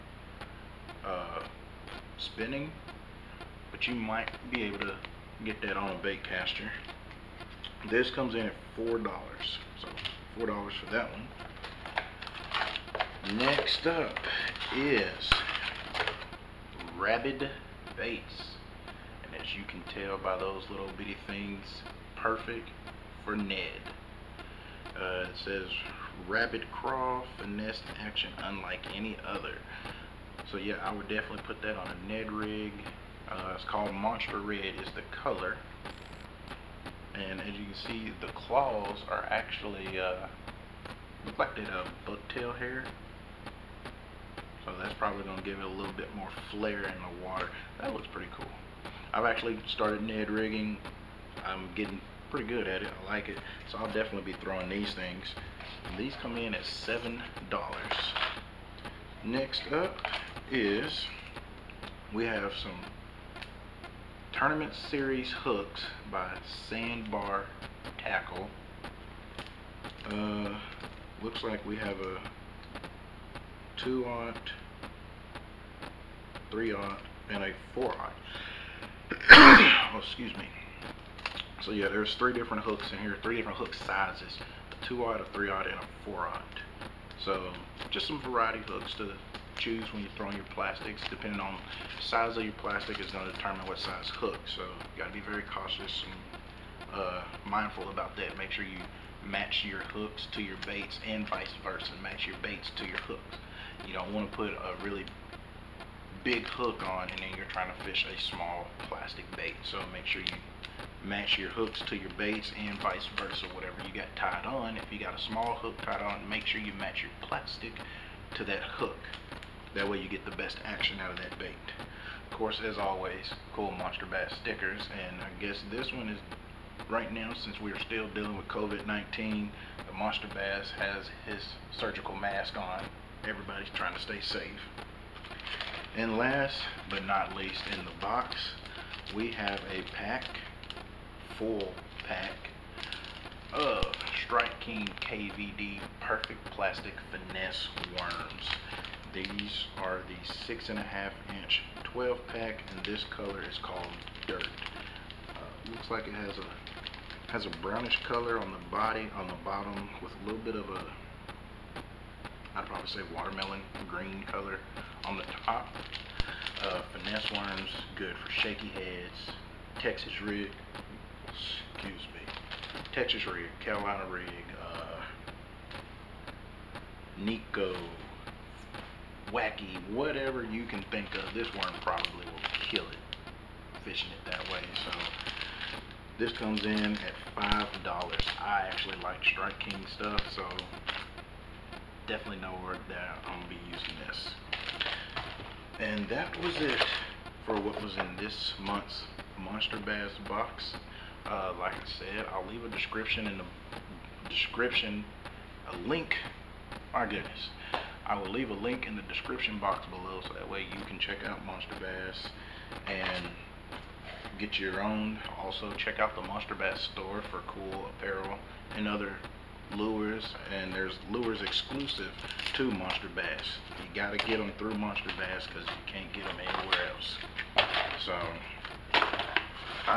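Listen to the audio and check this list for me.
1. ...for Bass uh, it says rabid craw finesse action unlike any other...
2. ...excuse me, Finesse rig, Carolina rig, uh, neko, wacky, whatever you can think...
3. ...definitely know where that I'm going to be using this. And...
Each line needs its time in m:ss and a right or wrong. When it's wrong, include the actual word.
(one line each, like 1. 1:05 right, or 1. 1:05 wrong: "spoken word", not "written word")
1. 0:23 wrong: "Ned", not "Bass"
2. 2:51 wrong: "Texas", not "Finesse"
3. 3:12 right.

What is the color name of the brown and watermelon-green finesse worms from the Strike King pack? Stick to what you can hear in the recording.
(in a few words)
Dirt.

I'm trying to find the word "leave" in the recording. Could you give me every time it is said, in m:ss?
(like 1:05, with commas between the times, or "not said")
3:22, 3:28.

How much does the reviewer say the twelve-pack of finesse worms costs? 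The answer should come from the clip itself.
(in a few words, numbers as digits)
$5.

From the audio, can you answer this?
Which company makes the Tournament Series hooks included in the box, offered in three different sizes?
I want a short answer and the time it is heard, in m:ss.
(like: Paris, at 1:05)
Sandbar Tackle, at 1:06.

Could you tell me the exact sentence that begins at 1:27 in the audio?
So just some variety hooks to choose when you are throwing your plastics.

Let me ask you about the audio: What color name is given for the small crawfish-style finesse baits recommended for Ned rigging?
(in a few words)
Monster Red.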